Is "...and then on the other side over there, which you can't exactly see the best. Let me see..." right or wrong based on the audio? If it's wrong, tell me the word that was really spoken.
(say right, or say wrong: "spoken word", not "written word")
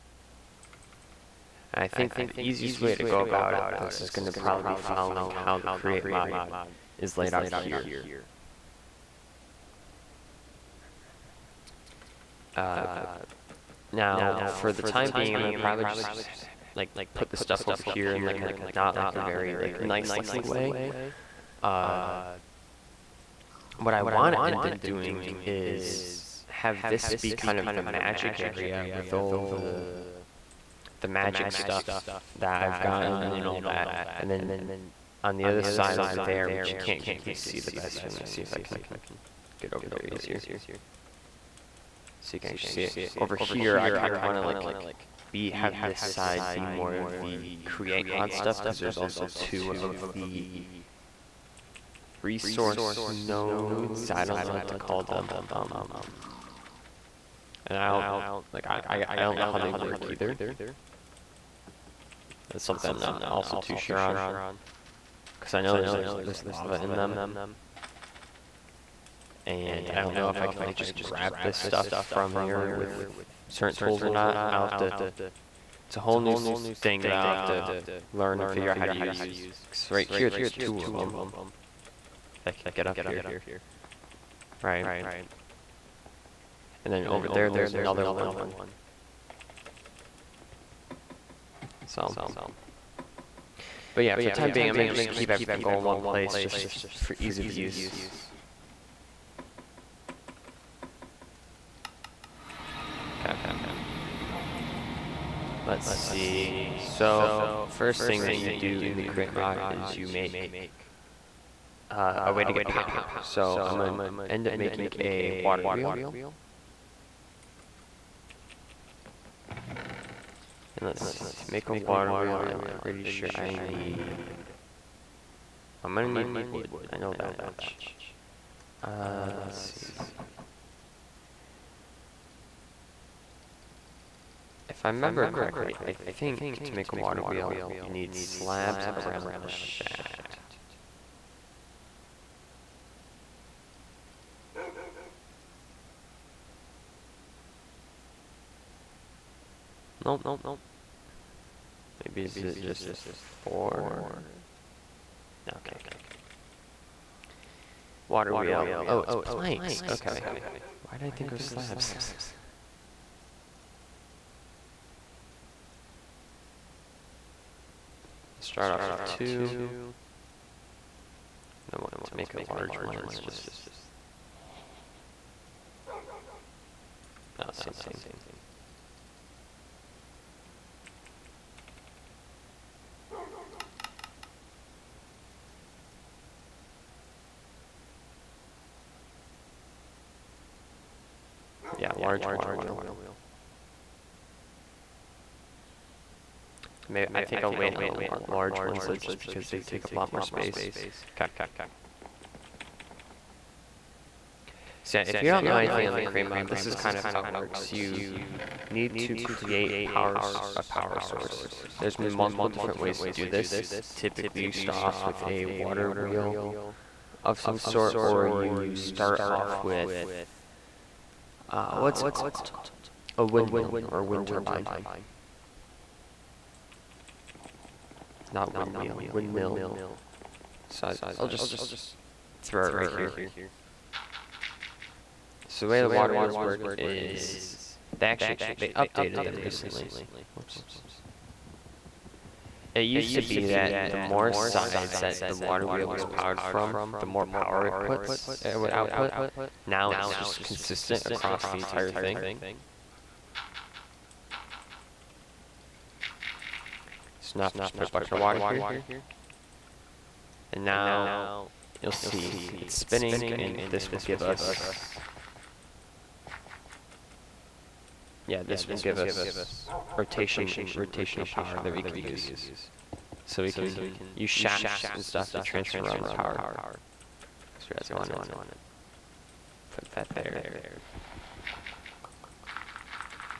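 right.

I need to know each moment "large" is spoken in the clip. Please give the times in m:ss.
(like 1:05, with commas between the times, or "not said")
2:52, 3:11, 3:18.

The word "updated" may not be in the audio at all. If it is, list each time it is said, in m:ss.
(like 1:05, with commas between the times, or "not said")
3:58.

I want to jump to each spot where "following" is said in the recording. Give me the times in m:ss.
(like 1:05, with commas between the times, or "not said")
0:04.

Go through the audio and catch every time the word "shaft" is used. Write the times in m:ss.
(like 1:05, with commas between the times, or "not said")
2:19, 4:34.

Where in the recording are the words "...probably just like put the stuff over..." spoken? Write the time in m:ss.
0:15.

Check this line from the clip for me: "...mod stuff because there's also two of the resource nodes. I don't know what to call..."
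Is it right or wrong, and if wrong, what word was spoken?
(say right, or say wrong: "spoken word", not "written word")
right.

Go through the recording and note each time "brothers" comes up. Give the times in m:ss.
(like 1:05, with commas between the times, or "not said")
not said.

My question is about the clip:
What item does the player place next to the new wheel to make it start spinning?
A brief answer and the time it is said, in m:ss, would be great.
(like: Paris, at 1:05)
A bucket of water, at 4:17.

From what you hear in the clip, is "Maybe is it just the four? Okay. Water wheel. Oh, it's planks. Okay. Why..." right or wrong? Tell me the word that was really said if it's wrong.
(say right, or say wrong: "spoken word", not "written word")
right.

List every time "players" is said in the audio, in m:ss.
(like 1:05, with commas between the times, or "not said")
not said.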